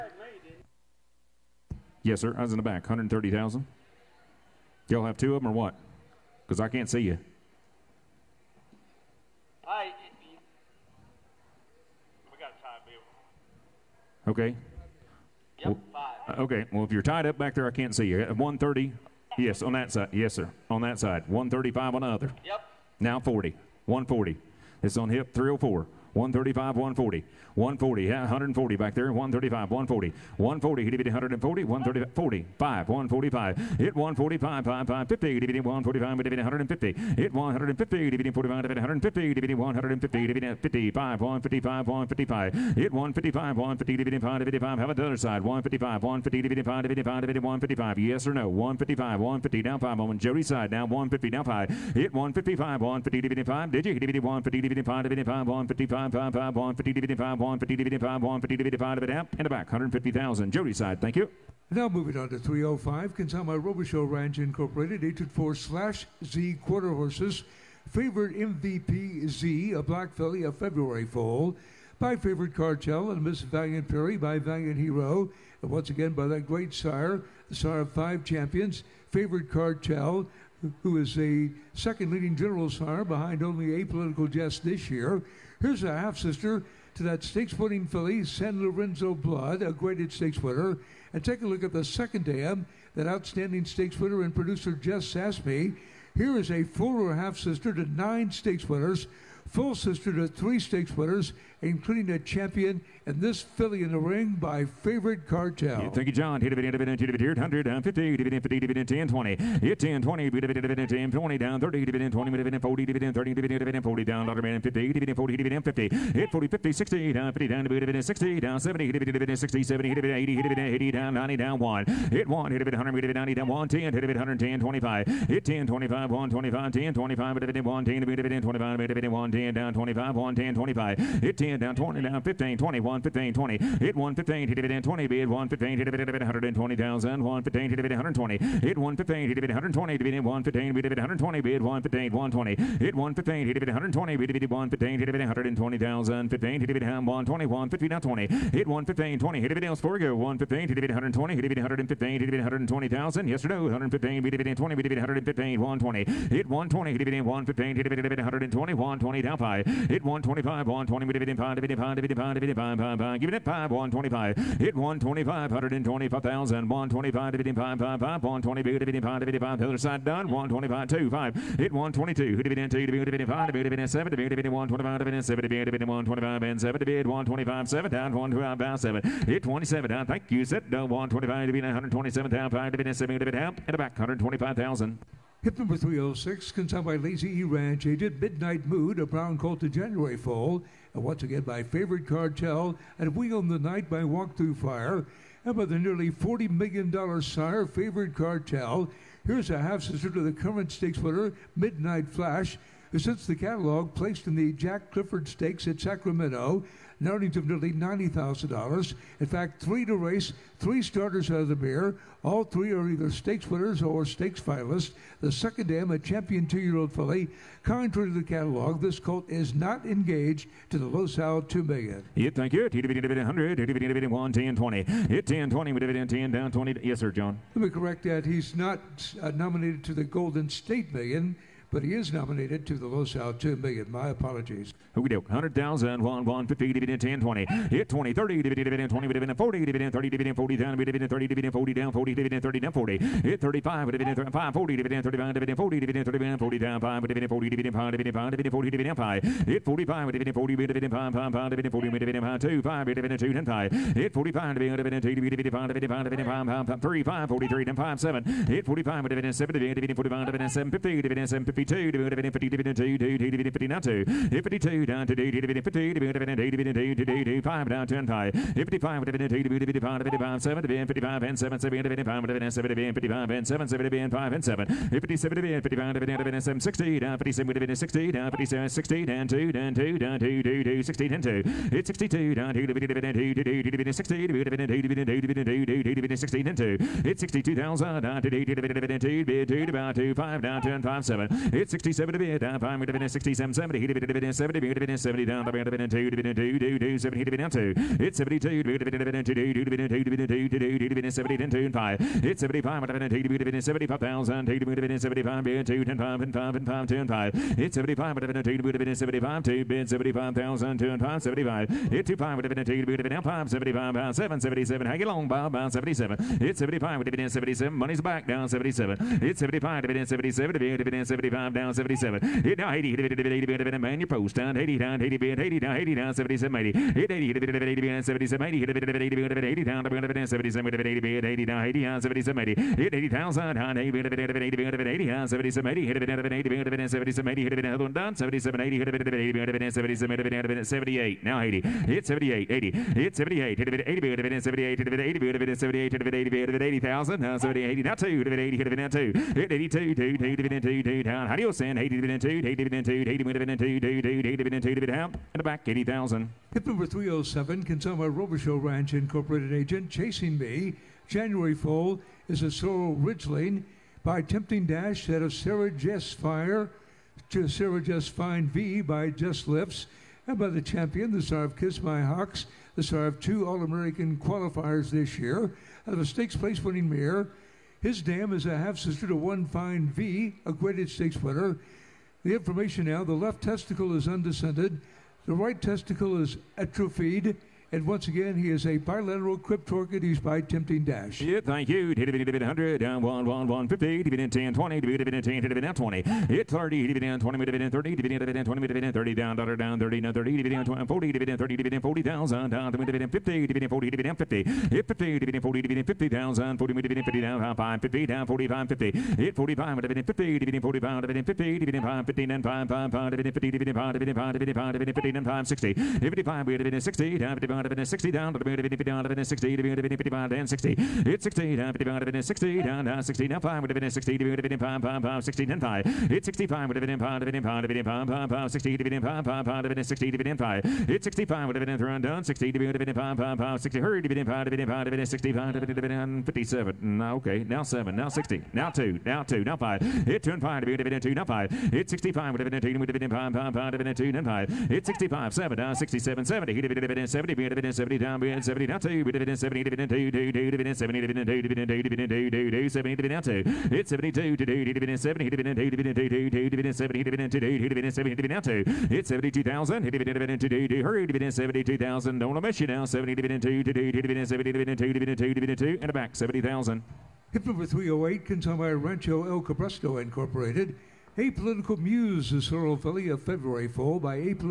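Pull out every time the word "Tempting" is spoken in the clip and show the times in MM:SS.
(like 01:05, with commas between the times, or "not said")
06:04, 06:30.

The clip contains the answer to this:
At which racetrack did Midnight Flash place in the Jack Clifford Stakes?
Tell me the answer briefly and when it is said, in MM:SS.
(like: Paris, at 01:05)
Sacramento, at 03:25.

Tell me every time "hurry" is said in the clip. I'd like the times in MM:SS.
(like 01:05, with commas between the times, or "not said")
07:13, 07:40.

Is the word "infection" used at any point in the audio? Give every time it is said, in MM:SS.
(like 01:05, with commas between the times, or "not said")
not said.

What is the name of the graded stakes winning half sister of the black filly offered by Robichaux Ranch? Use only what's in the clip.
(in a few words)
San Lorenzo Blood.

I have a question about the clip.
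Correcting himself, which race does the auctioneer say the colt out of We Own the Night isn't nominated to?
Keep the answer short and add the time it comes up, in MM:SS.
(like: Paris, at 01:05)
Golden State Million, at 03:50.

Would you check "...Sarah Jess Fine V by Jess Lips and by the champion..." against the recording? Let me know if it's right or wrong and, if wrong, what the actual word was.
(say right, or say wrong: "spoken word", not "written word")
right.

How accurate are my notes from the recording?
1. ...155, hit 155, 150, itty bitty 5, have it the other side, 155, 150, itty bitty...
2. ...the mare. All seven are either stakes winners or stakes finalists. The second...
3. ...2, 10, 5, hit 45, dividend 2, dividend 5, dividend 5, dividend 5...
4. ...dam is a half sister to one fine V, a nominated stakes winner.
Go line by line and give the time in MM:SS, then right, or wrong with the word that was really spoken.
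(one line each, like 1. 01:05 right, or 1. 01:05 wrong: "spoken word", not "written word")
1. 00:41 right
2. 03:31 wrong: "three", not "seven"
3. 04:13 right
4. 06:18 wrong: "graded", not "nominated".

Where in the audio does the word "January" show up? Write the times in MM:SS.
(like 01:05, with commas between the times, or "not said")
03:09, 06:01.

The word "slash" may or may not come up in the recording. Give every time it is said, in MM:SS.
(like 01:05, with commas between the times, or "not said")
01:05.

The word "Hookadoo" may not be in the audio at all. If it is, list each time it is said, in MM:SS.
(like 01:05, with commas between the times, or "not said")
03:54.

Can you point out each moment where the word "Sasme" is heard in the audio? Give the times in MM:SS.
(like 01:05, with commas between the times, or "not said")
01:35.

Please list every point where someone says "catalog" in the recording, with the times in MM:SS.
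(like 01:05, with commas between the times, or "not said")
03:23, 03:38.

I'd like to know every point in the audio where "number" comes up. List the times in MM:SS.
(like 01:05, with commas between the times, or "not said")
03:05, 05:56, 07:47.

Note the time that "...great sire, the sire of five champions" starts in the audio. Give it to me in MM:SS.
01:16.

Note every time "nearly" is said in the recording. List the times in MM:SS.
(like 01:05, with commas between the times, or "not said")
03:15, 03:27.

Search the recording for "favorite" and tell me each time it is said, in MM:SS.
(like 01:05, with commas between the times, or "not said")
01:07, 01:12, 01:19, 03:11, 03:17.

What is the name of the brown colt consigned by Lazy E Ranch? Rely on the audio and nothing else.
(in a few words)
Midnight Mood.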